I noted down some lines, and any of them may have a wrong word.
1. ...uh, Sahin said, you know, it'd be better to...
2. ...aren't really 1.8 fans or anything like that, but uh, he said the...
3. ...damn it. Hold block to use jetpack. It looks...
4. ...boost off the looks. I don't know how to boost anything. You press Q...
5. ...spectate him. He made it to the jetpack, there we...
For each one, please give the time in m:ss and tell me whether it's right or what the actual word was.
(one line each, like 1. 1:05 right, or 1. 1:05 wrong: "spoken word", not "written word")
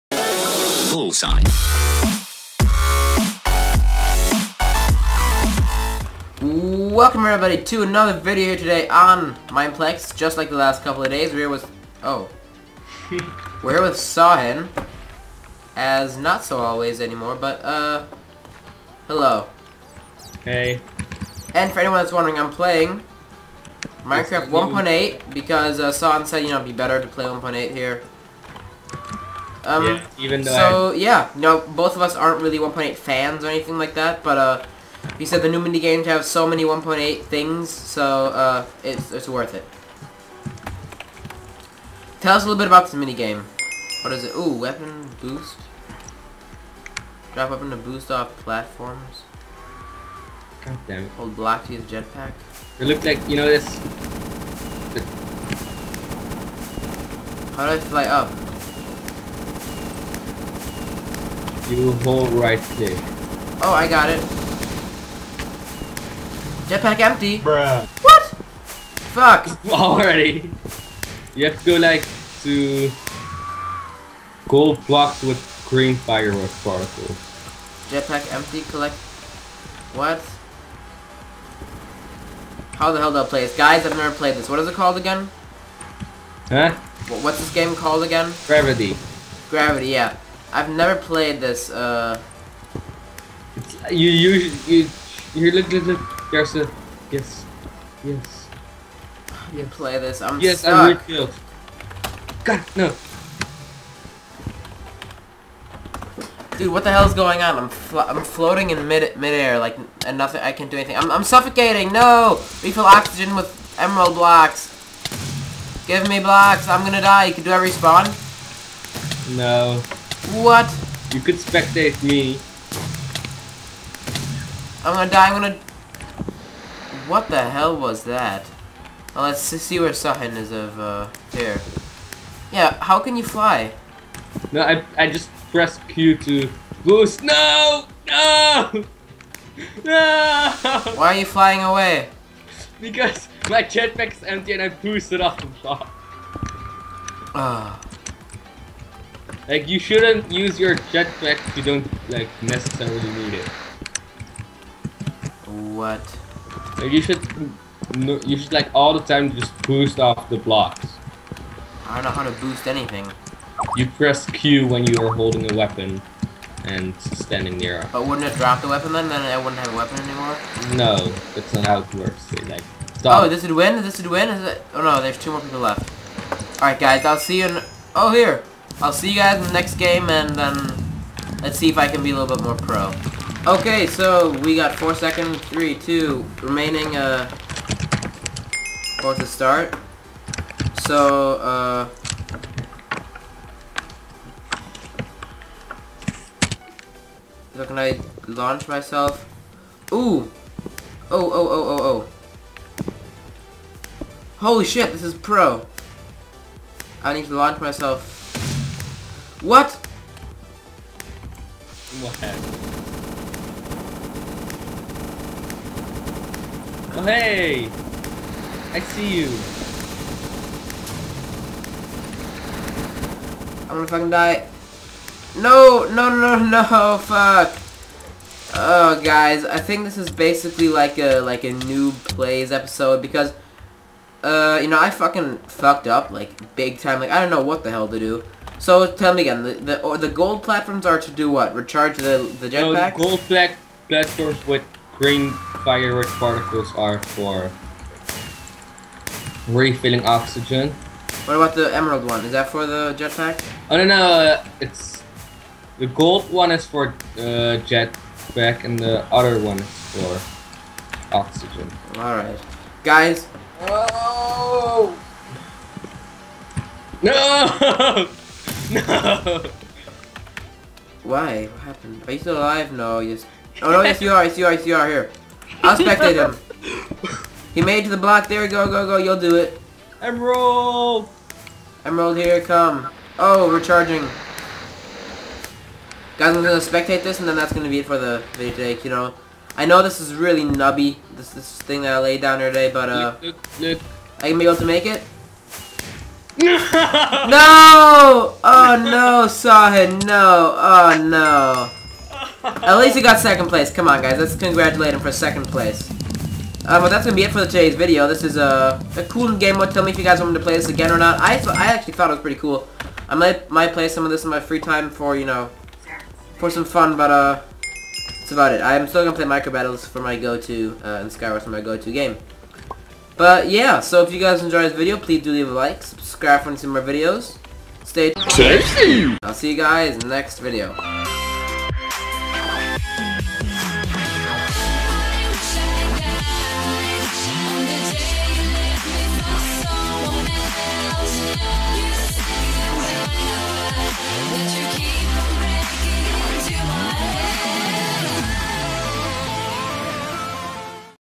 1. 0:25 right
2. 0:32 right
3. 0:50 right
4. 2:39 wrong: "blocks", not "looks"
5. 4:35 wrong: "block", not "jetpack".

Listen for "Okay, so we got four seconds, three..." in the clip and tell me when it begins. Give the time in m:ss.
3:03.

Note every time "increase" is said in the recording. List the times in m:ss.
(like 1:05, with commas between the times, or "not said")
not said.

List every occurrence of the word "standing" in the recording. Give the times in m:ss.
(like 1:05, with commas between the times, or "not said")
2:47.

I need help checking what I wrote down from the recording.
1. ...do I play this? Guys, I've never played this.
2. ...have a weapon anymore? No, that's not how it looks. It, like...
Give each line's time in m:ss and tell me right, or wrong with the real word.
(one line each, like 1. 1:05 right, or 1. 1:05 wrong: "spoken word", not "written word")
1. 1:23 right
2. 2:49 wrong: "works", not "looks".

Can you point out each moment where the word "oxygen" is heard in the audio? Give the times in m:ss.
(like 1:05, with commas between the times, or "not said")
1:52, 4:10, 4:21.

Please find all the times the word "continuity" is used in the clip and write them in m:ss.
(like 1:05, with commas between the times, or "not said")
not said.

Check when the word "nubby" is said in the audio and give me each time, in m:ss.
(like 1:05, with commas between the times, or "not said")
4:50.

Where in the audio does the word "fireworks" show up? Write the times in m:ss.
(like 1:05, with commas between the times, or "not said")
1:15, 4:05.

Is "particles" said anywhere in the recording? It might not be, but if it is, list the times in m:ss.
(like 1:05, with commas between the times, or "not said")
1:16, 4:06.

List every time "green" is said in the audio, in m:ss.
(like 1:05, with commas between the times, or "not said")
1:15, 4:04.